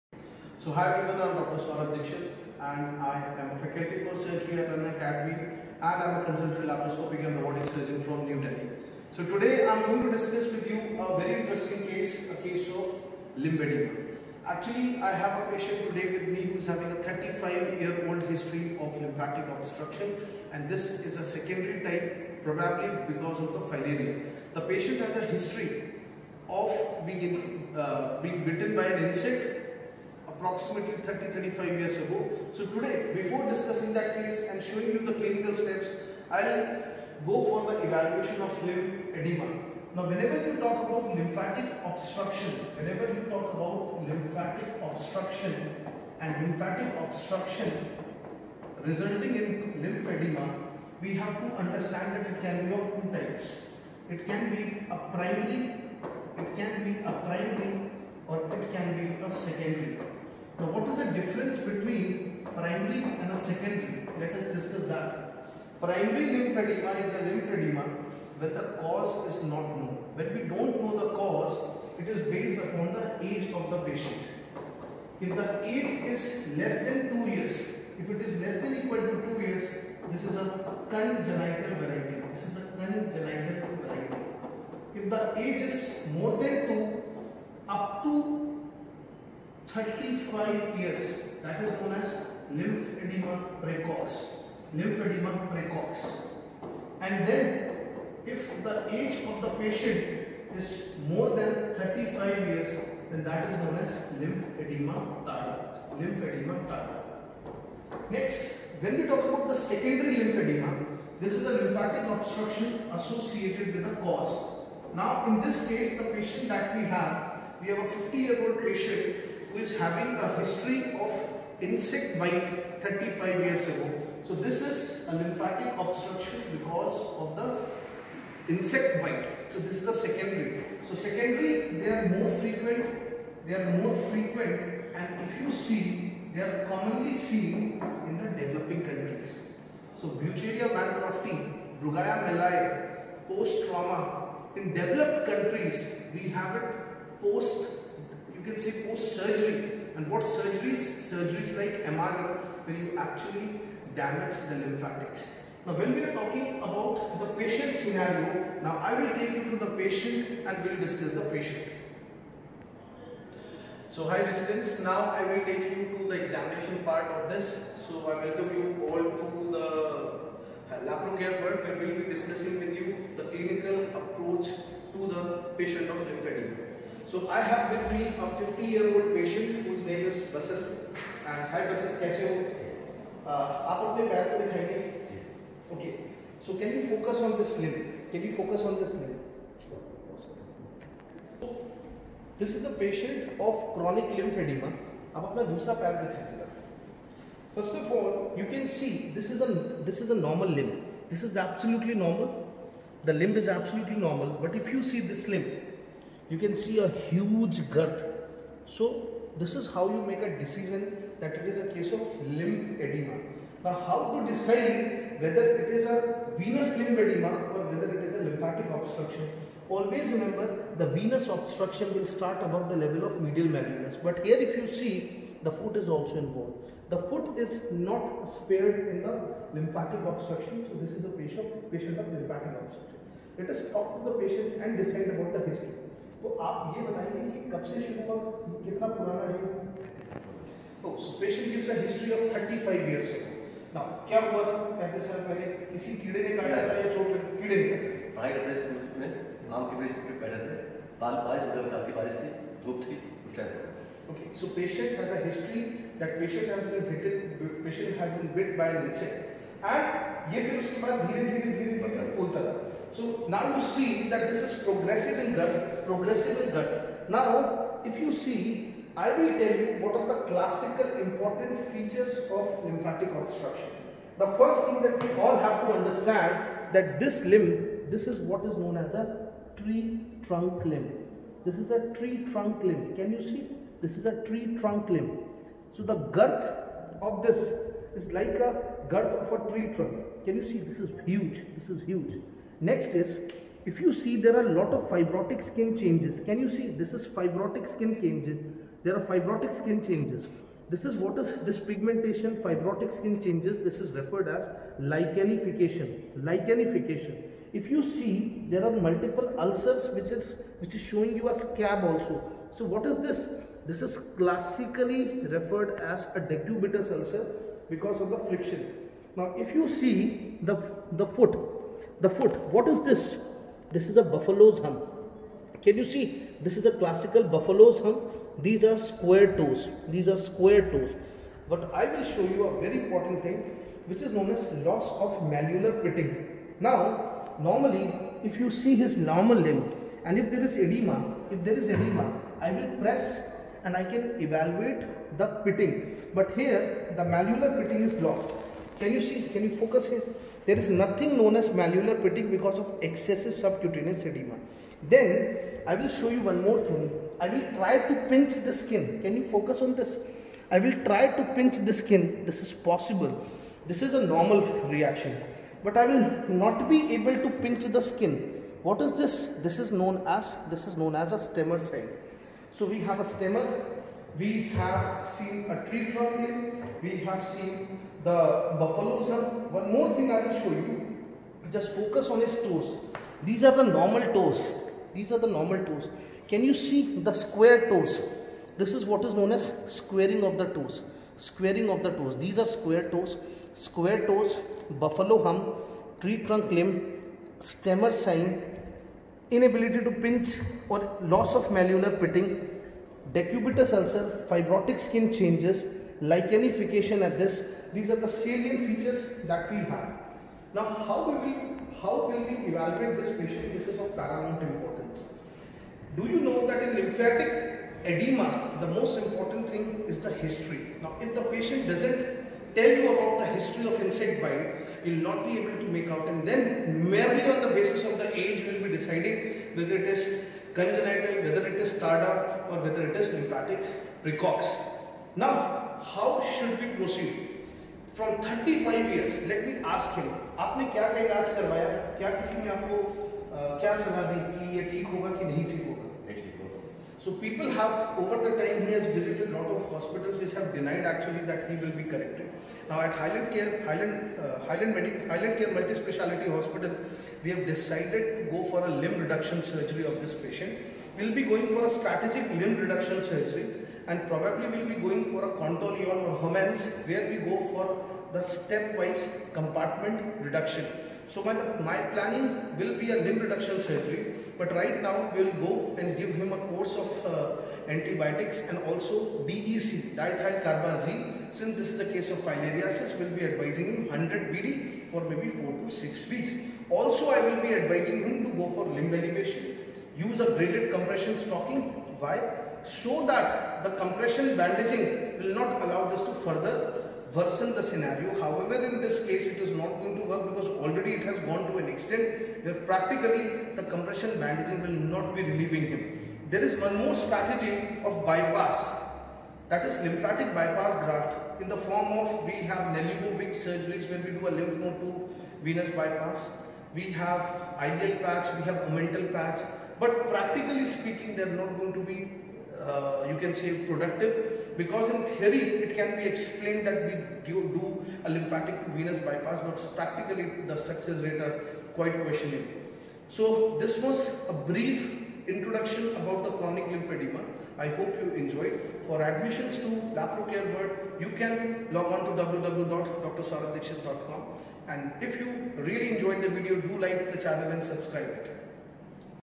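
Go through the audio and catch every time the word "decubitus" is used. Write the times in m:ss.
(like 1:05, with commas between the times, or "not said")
5:16, 6:43.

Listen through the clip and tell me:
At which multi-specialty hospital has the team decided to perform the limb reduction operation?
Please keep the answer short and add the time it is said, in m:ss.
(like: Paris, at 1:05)
Highland Care Multi Speciality Hospital, at 7:35.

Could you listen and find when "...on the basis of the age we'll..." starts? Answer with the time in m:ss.
7:07.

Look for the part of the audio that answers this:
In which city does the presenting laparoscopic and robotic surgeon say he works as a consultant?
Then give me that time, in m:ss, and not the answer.
0:08.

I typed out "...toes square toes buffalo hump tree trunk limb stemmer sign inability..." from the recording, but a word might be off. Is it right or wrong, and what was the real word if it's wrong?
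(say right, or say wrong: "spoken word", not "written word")
right.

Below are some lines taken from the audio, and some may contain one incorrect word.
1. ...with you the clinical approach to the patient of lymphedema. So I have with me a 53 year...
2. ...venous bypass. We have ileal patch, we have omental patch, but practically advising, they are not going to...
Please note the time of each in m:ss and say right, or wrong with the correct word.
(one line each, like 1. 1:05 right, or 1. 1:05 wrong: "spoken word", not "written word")
1. 2:52 wrong: "50", not "53"
2. 8:35 wrong: "speaking", not "advising".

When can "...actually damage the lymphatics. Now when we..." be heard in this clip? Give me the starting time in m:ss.
2:32.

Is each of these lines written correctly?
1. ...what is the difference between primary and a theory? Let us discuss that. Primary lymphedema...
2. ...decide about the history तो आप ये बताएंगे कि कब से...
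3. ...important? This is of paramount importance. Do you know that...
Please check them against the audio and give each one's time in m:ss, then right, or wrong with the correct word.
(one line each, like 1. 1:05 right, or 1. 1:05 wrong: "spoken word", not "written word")
1. 1:00 wrong: "secondary", not "theory"
2. 3:54 right
3. 6:53 wrong: "patient", not "important".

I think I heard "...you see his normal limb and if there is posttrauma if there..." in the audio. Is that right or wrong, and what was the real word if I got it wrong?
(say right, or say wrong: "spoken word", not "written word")
wrong: "edema", not "posttrauma".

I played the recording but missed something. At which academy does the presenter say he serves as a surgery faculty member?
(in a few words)
Anna Academy.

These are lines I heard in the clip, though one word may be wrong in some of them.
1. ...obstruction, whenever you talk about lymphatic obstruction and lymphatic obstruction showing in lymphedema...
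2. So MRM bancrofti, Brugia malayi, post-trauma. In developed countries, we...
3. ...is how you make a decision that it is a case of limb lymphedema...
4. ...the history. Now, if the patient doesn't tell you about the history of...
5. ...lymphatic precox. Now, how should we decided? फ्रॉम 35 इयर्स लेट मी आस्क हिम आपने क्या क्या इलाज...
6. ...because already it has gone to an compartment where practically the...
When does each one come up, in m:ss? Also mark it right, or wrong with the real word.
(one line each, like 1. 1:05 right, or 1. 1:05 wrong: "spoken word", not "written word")
1. 0:41 wrong: "resulting", not "showing"
2. 2:19 wrong: "Wuchereria", not "MRM"
3. 3:29 wrong: "edema", not "lymphedema"
4. 7:00 right
5. 7:13 wrong: "proceed", not "decided"
6. 8:20 wrong: "extent", not "compartment".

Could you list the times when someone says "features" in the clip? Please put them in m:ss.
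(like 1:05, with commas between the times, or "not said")
4:31, 6:48.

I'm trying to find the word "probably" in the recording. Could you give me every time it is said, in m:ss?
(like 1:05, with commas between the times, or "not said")
0:22, 7:44.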